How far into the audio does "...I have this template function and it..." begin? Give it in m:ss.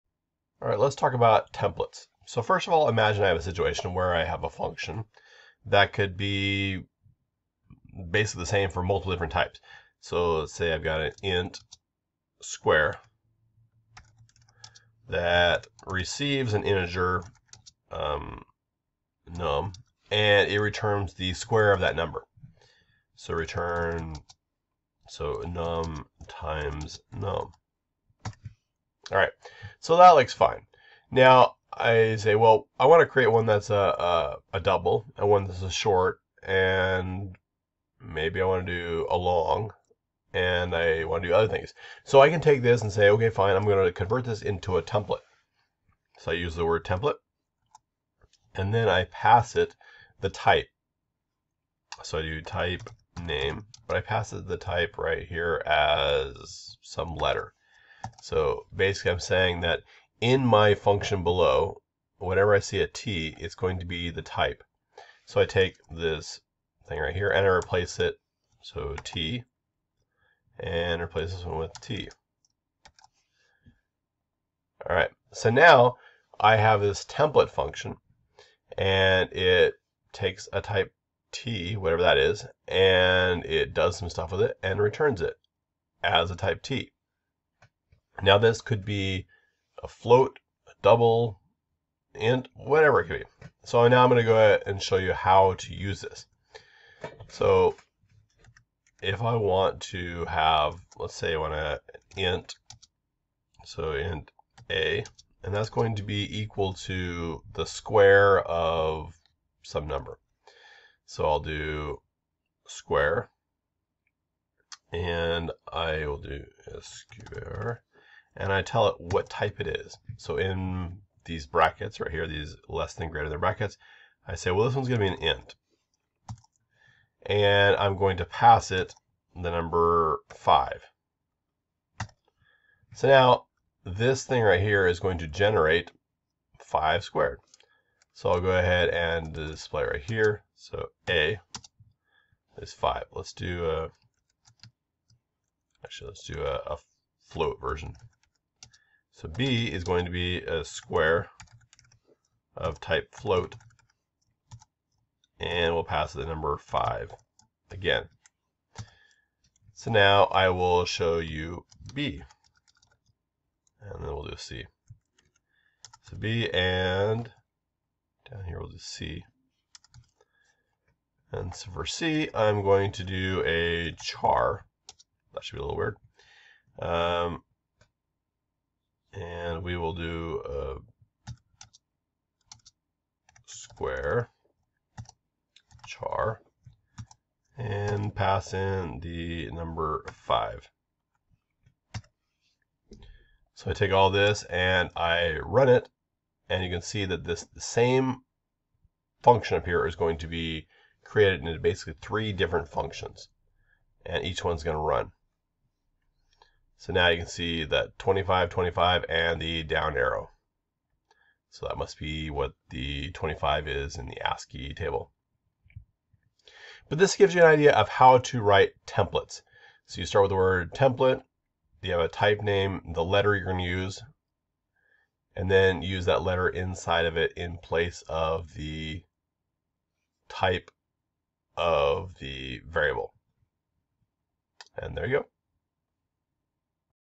1:16.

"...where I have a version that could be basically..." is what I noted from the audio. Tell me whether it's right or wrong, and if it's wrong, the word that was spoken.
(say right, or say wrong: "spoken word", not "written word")
wrong: "function", not "version".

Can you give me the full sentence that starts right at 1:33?
So now I'm going to go ahead and show you how to use this.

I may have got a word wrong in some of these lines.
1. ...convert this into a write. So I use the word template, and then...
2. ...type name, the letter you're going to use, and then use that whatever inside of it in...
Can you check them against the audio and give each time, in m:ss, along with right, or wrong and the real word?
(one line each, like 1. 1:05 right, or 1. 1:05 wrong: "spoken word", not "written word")
1. 0:43 wrong: "template", not "write"
2. 3:42 wrong: "letter", not "whatever".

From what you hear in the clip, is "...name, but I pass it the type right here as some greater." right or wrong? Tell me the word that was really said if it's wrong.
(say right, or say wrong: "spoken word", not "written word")
wrong: "letter", not "greater".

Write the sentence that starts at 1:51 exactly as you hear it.
So I'll do square, and I will do square, and I tell it what type it is.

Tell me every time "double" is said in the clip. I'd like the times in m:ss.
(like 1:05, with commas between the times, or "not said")
0:34, 1:30.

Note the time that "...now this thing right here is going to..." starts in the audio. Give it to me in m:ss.
2:13.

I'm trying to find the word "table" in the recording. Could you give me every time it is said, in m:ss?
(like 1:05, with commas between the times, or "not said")
3:34.